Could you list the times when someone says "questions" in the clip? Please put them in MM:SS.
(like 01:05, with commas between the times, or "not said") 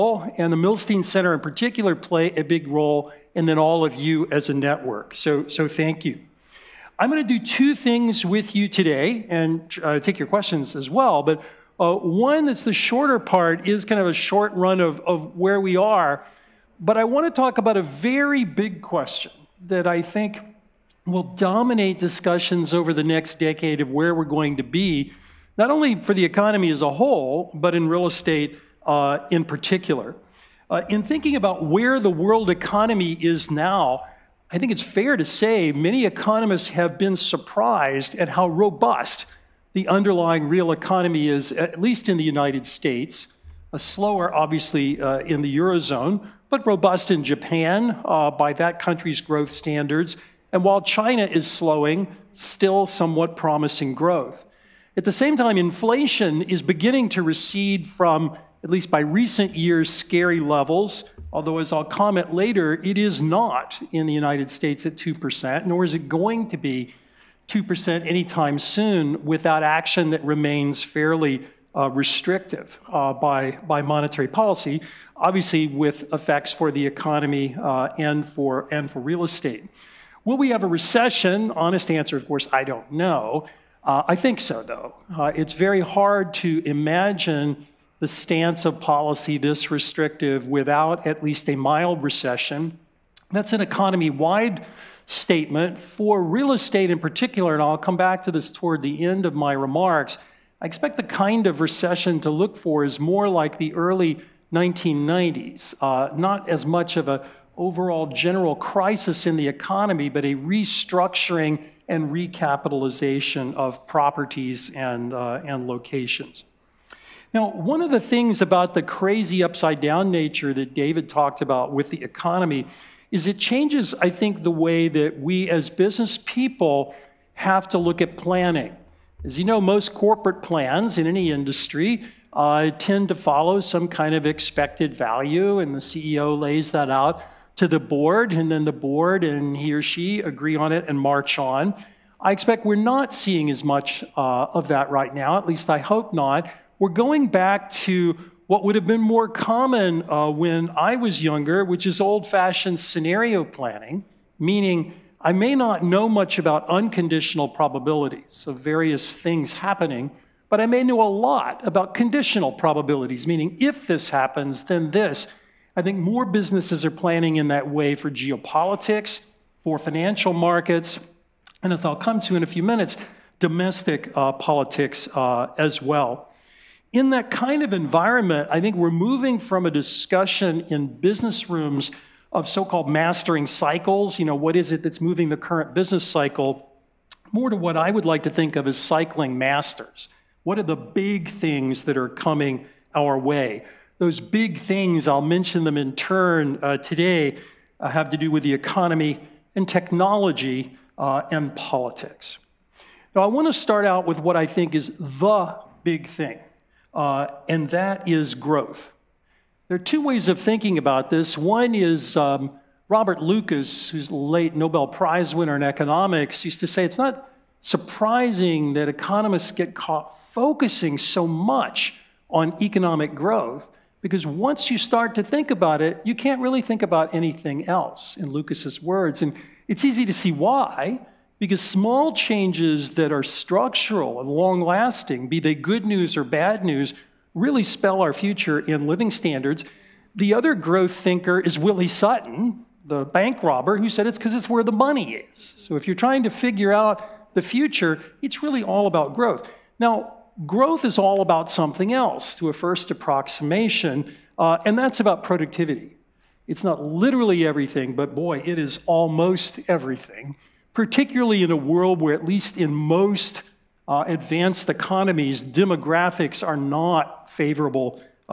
00:10, 00:18.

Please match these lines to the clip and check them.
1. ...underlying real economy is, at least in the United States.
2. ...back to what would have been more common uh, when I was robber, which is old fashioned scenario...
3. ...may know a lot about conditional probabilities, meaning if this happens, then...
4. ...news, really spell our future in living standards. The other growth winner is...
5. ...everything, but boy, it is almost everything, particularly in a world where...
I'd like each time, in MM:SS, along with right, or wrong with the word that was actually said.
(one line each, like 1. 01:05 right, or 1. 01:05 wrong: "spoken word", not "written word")
1. 00:39 right
2. 02:27 wrong: "younger", not "robber"
3. 02:40 right
4. 03:56 wrong: "thinker", not "winner"
5. 04:17 right.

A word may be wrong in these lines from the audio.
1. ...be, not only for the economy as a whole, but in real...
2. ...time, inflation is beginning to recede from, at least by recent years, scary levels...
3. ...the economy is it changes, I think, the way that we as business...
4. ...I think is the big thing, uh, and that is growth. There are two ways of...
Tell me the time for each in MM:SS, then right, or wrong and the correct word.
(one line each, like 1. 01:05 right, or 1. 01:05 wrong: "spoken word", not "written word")
1. 00:24 right
2. 00:55 right
3. 02:01 right
4. 03:24 right.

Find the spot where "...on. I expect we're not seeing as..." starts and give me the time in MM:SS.
02:21.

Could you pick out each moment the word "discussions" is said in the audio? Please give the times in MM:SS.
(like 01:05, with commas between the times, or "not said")
00:21, 02:59.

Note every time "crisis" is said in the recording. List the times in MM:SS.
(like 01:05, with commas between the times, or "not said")
01:48.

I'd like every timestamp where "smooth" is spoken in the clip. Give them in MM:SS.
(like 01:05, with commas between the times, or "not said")
not said.